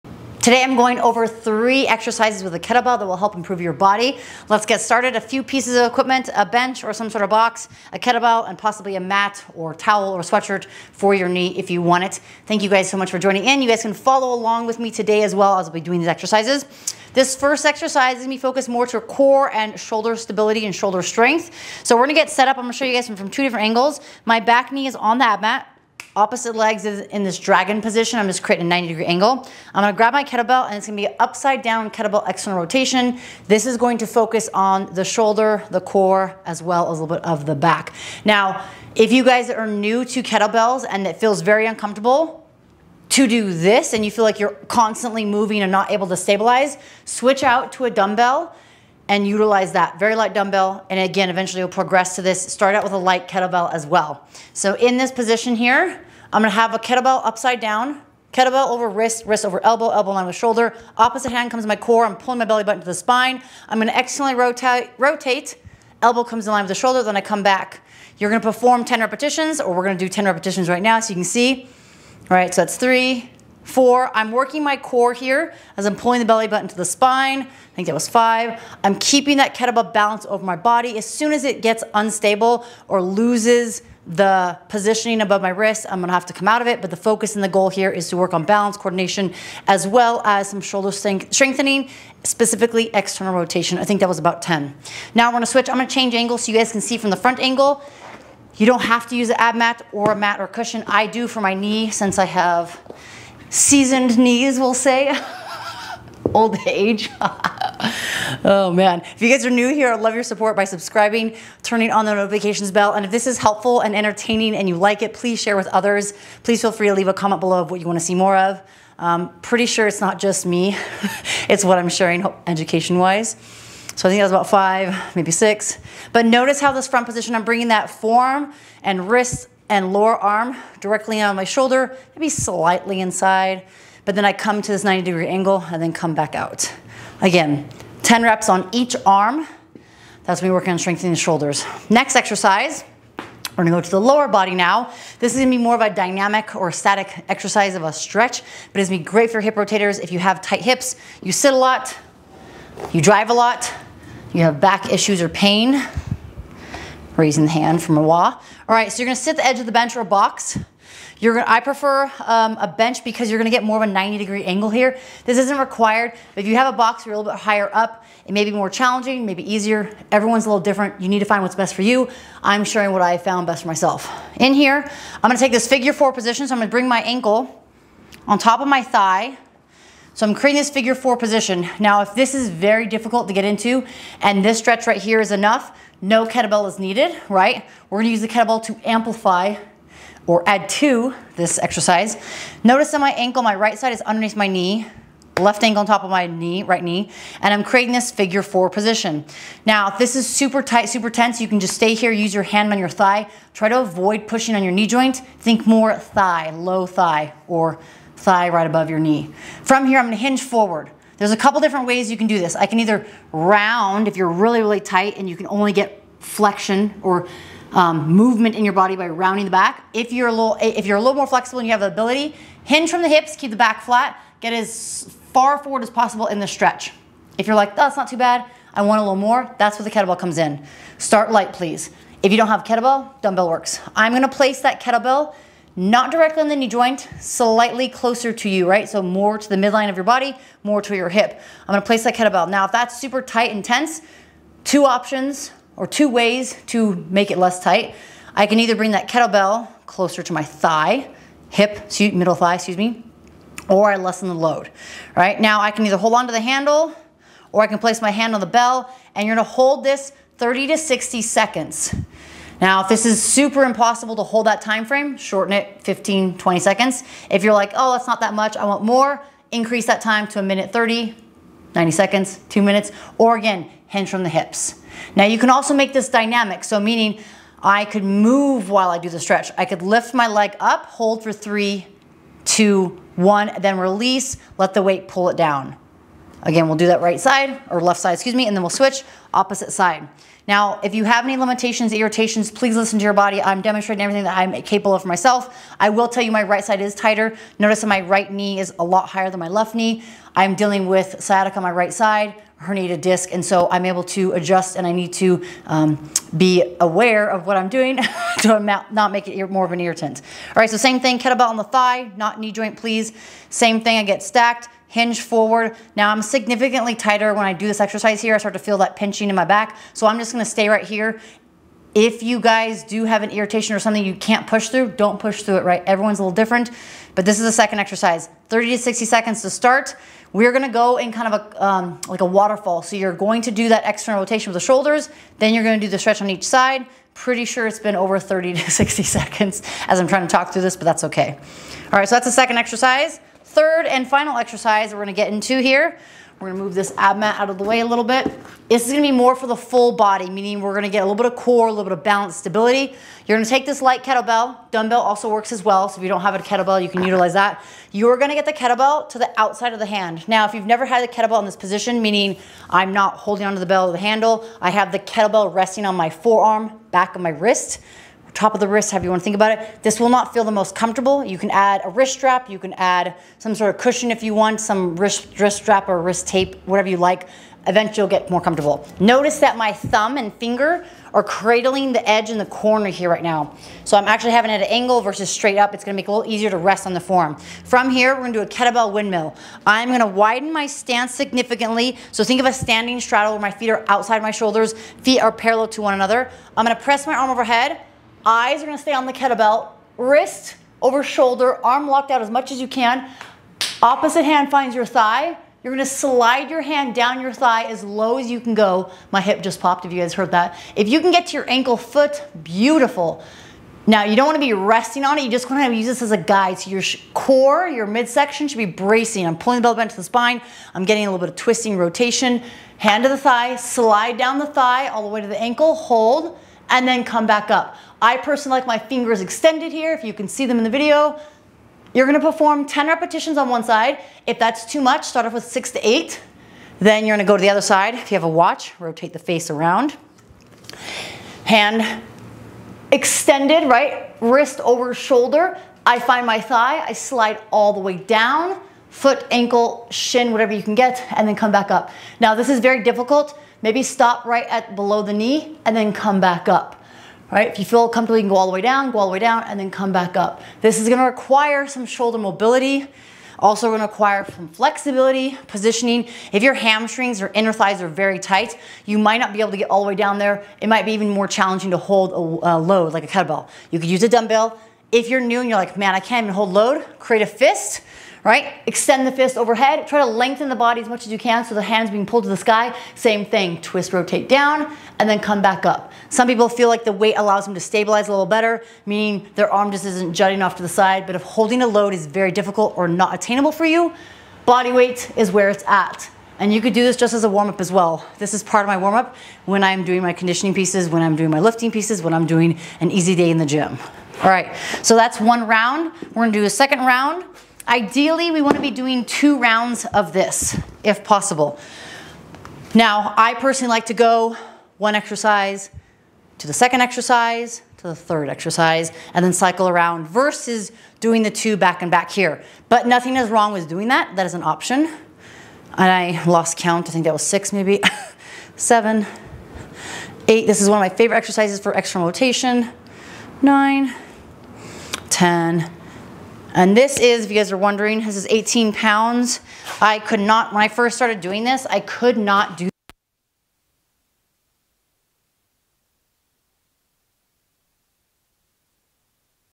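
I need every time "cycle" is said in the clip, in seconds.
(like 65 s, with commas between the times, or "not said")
519 s.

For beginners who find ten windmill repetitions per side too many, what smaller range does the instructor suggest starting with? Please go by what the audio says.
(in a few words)
6 to 8.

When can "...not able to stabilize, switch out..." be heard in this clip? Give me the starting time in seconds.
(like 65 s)
45 s.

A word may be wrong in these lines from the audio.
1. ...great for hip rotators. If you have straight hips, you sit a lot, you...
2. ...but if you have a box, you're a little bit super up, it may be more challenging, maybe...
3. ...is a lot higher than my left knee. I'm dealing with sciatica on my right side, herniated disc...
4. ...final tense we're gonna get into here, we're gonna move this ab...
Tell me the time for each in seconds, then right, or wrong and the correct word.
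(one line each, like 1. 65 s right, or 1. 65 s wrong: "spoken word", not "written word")
1. 149 s wrong: "tight", not "straight"
2. 166 s wrong: "higher", not "super"
3. 298 s right
4. 344 s wrong: "exercise", not "tense".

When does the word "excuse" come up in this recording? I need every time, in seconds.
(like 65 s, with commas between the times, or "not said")
252 s, 288 s.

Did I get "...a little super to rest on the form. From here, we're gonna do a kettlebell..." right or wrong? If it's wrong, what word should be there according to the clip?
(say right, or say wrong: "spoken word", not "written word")
wrong: "easier", not "super".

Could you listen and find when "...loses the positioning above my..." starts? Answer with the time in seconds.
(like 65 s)
83 s.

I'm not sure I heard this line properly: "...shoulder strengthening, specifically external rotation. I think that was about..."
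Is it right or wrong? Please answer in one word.
right.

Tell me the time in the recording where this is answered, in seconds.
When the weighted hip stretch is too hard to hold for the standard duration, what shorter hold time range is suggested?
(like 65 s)
265 s.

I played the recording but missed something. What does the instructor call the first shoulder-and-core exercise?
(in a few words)
Upside down kettlebell external rotation.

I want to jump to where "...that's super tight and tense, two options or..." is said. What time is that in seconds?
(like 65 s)
242 s.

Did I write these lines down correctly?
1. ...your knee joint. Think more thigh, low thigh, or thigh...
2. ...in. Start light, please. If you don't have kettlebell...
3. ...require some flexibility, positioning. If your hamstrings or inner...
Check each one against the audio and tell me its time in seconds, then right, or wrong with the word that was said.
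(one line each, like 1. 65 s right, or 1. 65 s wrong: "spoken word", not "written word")
1. 204 s right
2. 230 s right
3. 463 s right.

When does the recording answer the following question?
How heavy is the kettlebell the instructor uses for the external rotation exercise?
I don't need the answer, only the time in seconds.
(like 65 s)
538 s.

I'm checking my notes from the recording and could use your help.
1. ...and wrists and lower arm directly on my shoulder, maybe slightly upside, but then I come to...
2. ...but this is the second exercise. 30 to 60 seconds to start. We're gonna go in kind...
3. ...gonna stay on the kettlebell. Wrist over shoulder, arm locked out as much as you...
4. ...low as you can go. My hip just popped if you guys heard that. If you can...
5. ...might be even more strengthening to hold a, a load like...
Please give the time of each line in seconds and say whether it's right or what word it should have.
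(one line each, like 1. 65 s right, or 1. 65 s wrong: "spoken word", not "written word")
1. 128 s wrong: "inside", not "upside"
2. 327 s right
3. 398 s right
4. 407 s right
5. 470 s wrong: "challenging", not "strengthening".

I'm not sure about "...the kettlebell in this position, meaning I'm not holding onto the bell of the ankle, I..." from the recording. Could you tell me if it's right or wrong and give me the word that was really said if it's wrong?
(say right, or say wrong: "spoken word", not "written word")
wrong: "handle", not "ankle".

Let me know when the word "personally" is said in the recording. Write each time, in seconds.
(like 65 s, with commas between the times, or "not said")
428 s, 513 s.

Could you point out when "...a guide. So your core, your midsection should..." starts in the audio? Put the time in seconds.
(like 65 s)
416 s.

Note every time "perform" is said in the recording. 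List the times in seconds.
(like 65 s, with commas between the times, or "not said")
68 s, 432 s.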